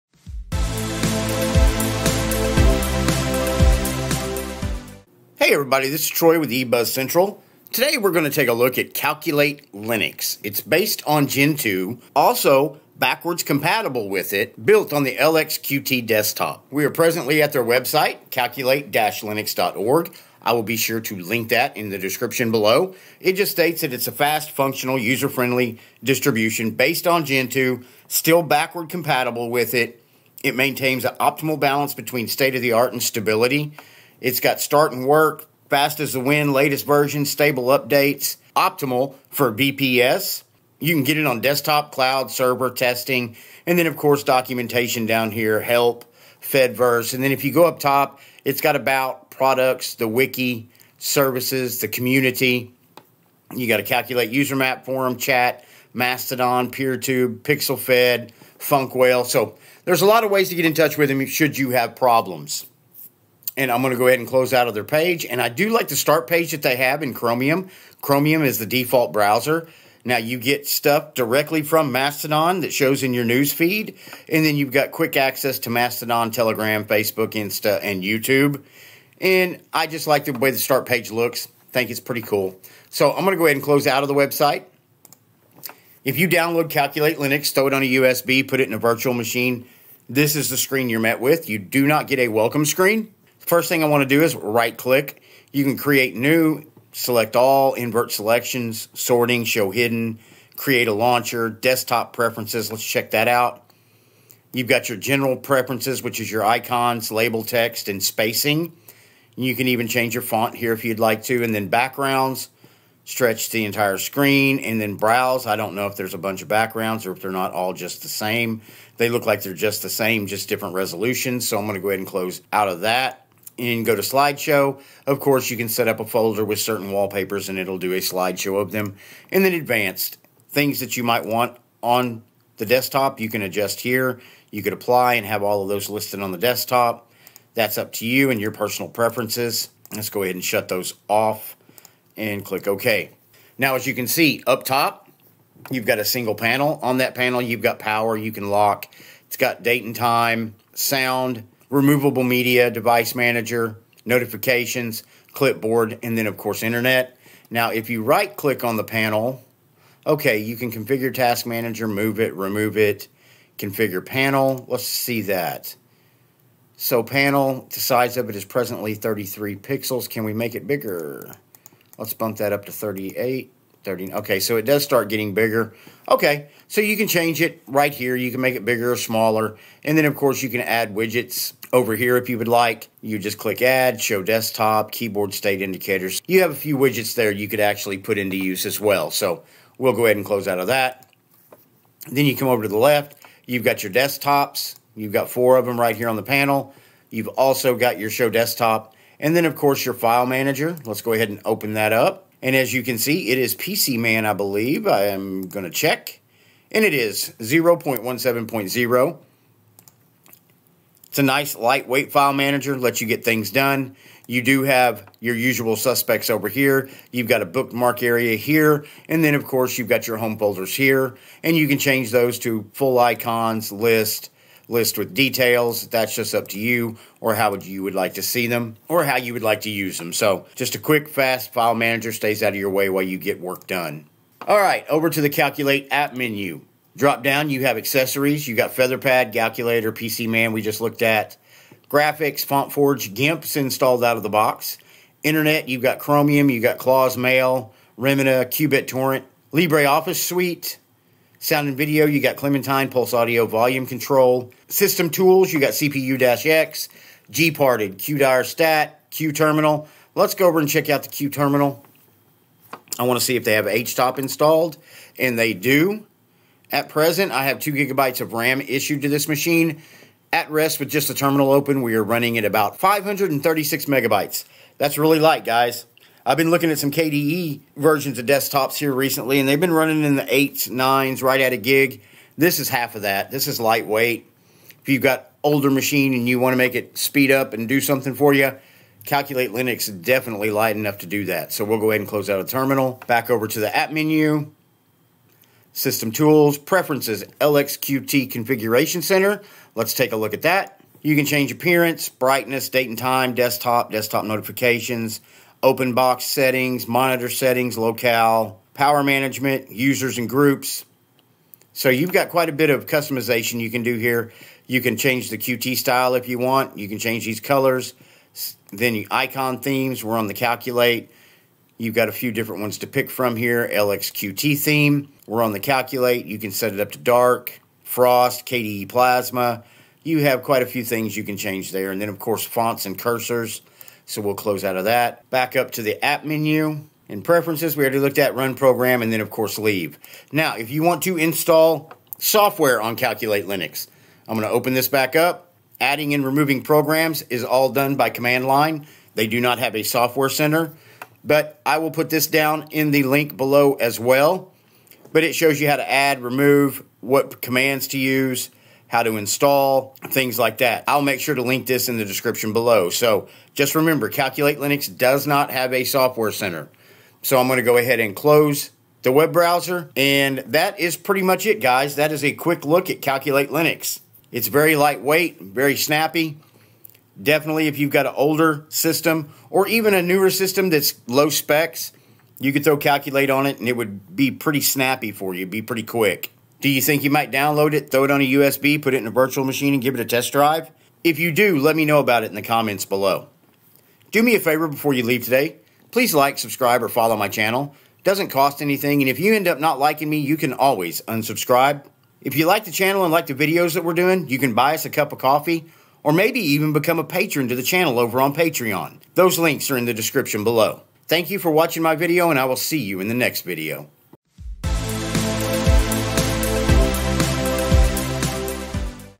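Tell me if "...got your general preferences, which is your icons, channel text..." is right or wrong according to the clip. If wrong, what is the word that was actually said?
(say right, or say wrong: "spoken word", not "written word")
wrong: "label", not "channel".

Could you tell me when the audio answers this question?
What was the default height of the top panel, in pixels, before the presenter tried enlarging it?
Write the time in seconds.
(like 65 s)
168 s.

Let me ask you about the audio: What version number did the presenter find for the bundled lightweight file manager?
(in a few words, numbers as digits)
0.17.0.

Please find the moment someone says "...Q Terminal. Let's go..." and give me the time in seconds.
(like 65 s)
259 s.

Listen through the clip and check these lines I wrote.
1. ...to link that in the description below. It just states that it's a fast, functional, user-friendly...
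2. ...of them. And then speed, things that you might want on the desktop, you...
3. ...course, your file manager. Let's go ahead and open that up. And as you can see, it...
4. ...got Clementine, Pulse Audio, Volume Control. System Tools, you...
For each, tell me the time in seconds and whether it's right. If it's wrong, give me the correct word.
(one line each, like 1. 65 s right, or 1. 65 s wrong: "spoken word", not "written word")
1. 21 s right
2. 128 s wrong: "advanced", not "speed"
3. 199 s right
4. 252 s right.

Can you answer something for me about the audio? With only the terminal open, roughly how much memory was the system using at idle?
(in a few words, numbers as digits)
536 megabytes.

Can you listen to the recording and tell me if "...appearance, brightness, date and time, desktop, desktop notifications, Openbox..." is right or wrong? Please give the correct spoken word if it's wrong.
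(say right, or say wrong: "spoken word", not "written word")
right.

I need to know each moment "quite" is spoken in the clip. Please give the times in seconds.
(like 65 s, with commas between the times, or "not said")
312 s, 330 s.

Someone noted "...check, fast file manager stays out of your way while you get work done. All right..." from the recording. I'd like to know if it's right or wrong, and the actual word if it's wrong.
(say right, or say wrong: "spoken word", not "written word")
wrong: "quick", not "check".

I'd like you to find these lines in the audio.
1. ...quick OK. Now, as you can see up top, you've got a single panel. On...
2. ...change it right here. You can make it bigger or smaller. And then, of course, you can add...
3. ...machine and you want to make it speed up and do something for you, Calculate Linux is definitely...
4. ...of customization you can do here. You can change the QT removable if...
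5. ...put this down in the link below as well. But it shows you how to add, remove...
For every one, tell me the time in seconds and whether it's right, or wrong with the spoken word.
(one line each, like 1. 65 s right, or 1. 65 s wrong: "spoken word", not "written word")
1. 142 s wrong: "click", not "quick"
2. 177 s right
3. 285 s right
4. 312 s wrong: "style", not "removable"
5. 351 s right.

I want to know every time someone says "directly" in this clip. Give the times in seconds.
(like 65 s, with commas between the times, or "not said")
71 s.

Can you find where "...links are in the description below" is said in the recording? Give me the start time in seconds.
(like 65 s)
409 s.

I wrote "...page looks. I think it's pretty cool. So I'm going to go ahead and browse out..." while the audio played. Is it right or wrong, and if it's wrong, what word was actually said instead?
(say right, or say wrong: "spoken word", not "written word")
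wrong: "close", not "browse".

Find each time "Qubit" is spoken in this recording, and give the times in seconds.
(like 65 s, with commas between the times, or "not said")
248 s.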